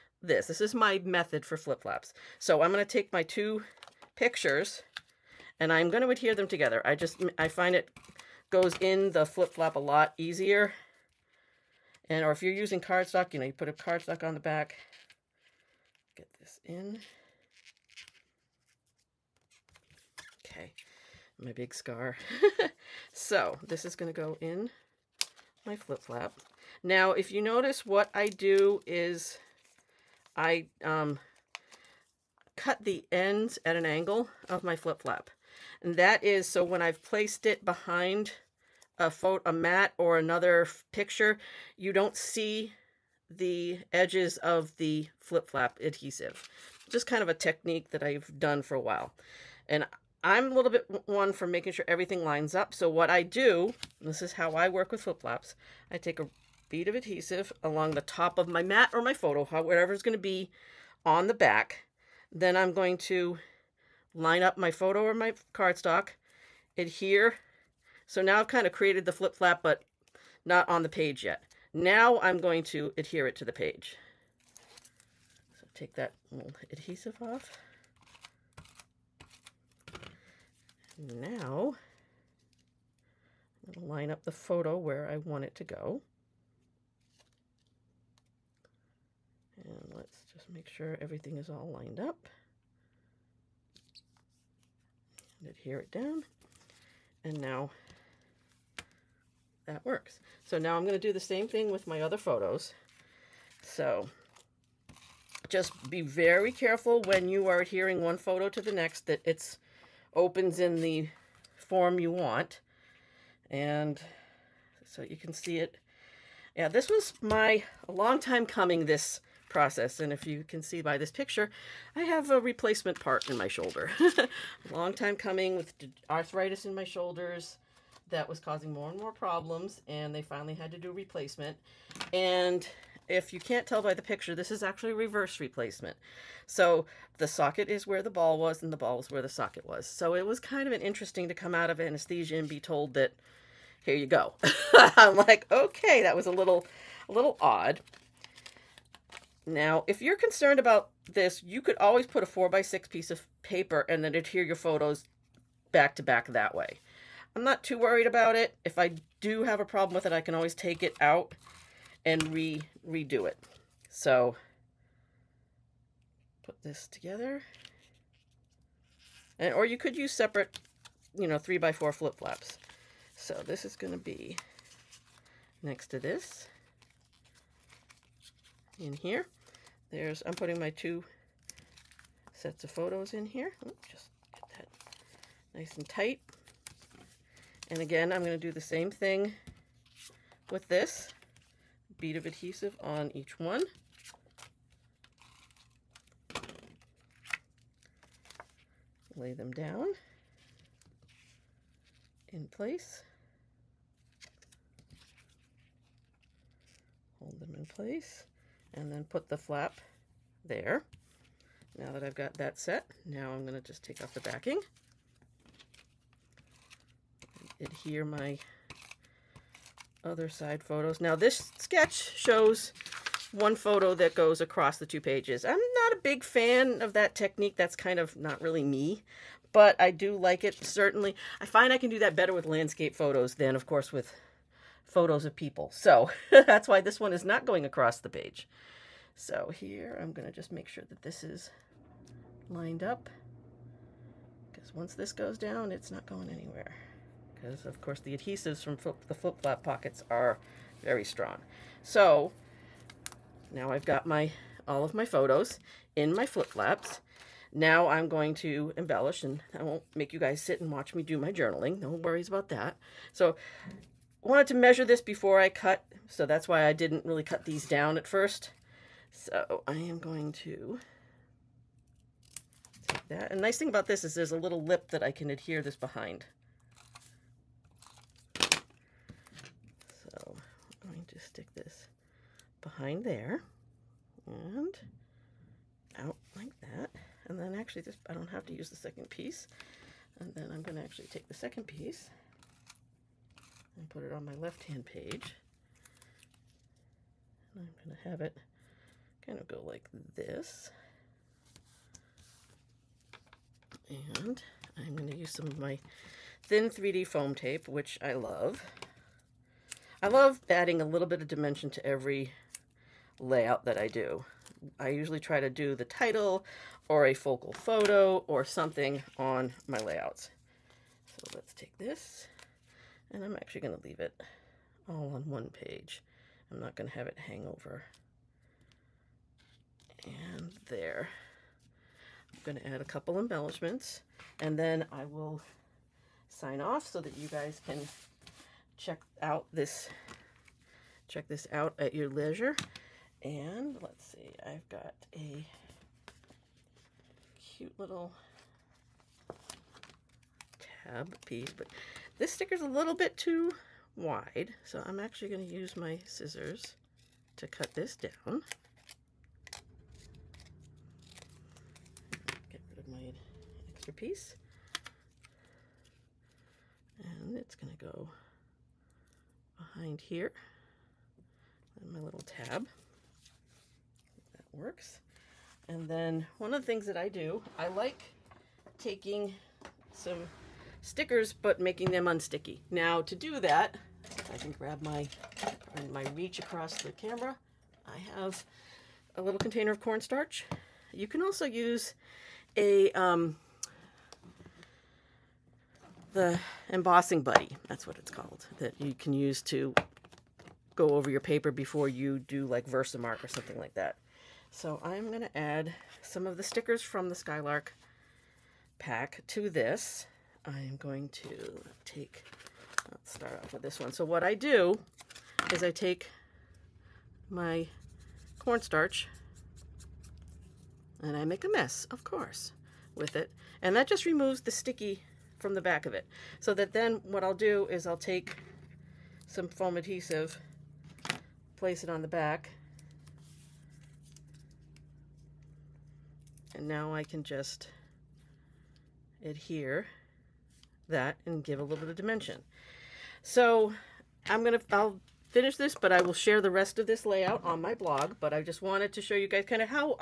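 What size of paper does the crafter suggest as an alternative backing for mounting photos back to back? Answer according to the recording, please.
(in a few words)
4 by 6.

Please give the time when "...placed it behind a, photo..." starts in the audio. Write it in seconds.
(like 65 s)
37 s.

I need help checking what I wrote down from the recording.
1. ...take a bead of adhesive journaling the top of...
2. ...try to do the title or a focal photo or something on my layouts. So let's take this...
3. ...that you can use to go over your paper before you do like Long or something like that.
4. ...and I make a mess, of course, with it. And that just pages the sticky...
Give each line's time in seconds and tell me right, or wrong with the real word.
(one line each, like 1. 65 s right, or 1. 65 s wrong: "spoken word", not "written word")
1. 55 s wrong: "along", not "journaling"
2. 315 s right
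3. 398 s wrong: "Versamark", not "Long"
4. 421 s wrong: "removes", not "pages".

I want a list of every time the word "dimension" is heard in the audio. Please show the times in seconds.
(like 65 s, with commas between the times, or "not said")
311 s, 441 s.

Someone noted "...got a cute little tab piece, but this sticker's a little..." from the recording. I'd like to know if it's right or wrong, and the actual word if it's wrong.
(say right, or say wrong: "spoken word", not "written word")
right.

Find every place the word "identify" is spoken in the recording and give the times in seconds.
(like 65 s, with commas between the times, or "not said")
not said.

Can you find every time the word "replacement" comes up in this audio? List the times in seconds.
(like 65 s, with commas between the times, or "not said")
122 s, 130 s, 135 s.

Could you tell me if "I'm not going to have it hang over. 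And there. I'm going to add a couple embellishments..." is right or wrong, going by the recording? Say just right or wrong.
right.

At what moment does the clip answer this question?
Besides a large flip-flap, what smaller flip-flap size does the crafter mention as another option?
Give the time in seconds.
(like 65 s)
171 s.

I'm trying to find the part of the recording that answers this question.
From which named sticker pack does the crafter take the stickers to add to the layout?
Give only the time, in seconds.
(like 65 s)
407 s.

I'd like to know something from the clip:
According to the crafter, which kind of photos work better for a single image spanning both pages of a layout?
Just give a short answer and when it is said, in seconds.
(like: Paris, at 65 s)
Landscape photos, at 232 s.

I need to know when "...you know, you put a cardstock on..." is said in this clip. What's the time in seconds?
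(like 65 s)
13 s.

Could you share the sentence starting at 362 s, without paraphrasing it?
Get rid of my extra piece.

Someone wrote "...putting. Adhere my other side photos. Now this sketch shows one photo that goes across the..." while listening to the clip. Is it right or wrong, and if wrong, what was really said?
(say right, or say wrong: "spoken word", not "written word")
wrong: "backing", not "putting".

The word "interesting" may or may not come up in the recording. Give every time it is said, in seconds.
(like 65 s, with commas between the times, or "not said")
140 s.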